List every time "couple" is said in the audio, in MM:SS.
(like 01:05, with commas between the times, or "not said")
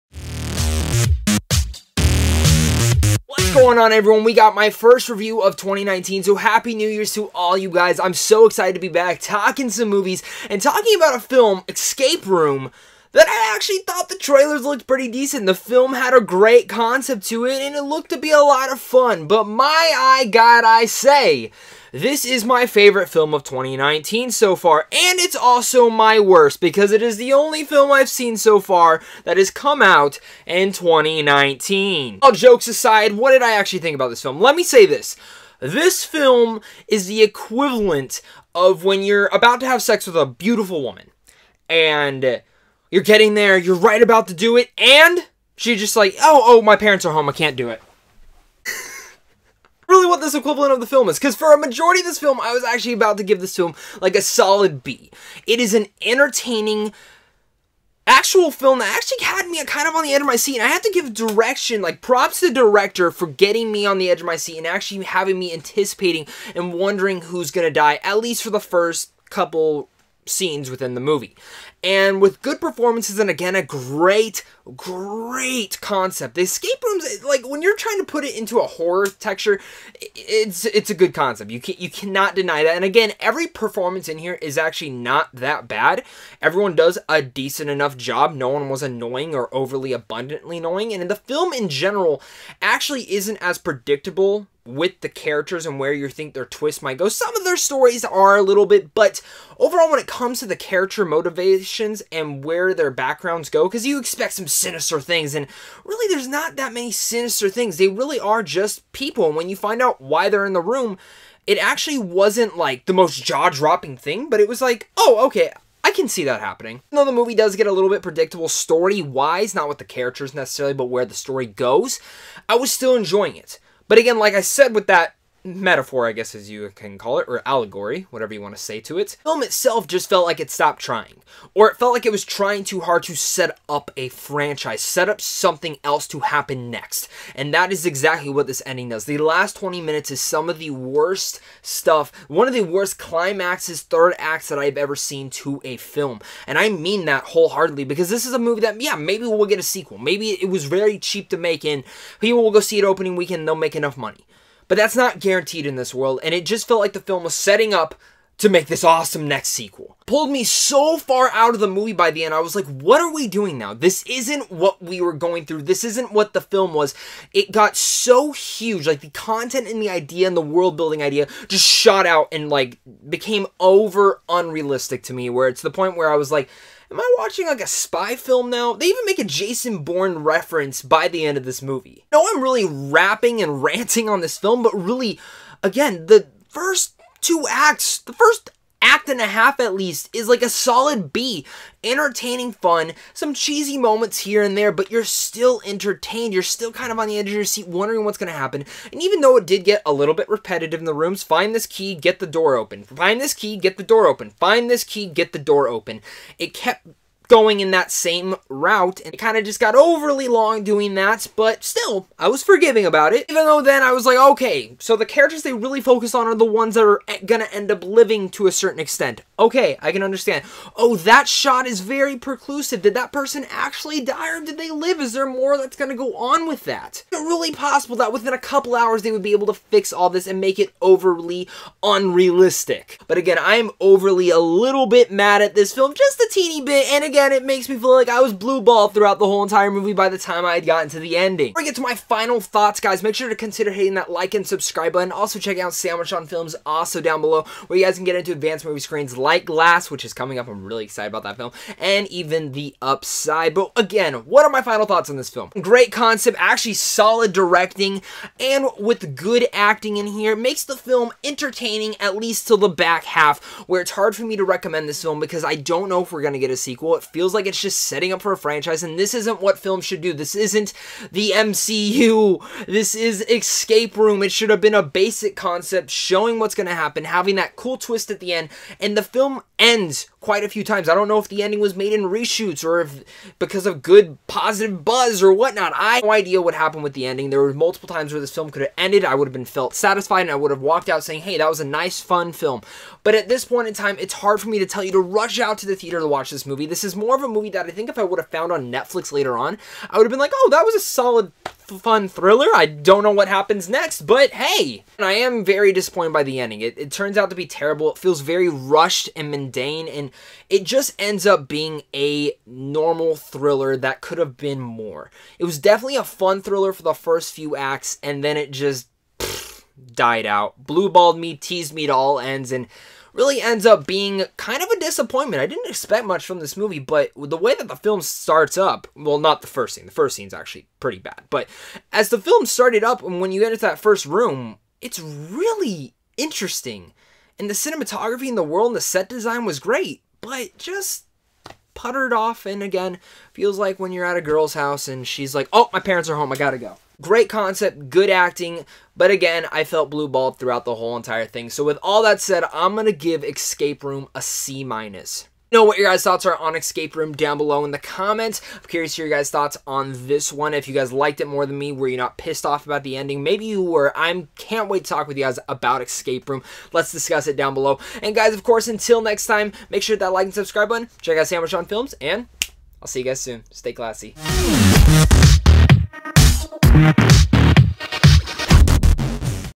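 01:09, 03:48.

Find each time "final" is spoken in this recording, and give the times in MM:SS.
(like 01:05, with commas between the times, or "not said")
04:01, 04:14.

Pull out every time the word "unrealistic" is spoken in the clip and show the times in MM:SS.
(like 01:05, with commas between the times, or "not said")
02:54, 03:51.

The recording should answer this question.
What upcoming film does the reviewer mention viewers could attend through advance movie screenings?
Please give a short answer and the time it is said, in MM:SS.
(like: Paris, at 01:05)
Glass, at 04:09.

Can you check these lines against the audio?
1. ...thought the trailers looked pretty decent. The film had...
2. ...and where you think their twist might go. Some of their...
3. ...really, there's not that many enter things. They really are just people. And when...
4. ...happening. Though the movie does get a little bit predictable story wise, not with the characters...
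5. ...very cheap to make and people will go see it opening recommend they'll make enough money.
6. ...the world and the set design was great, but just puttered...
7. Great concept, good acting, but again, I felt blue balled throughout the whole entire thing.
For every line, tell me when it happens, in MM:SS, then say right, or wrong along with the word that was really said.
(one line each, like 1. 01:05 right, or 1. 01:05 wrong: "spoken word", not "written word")
1. 00:13 right
2. 01:35 right
3. 01:45 wrong: "sinister", not "enter"
4. 01:56 right
5. 02:30 wrong: "weekend", not "recommend"
6. 05:38 right
7. 05:47 right.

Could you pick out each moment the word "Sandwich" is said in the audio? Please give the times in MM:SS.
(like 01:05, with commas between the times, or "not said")
04:05, 06:11.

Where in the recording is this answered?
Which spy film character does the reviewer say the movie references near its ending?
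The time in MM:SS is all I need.
02:59.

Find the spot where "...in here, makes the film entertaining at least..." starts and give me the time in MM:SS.
04:19.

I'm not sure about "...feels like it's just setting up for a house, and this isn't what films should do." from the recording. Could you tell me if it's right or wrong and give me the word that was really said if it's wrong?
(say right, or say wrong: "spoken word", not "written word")
wrong: "franchise", not "house".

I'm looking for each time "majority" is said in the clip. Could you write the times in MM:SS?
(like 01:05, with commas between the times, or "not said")
00:51.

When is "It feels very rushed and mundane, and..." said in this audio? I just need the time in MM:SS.
05:07.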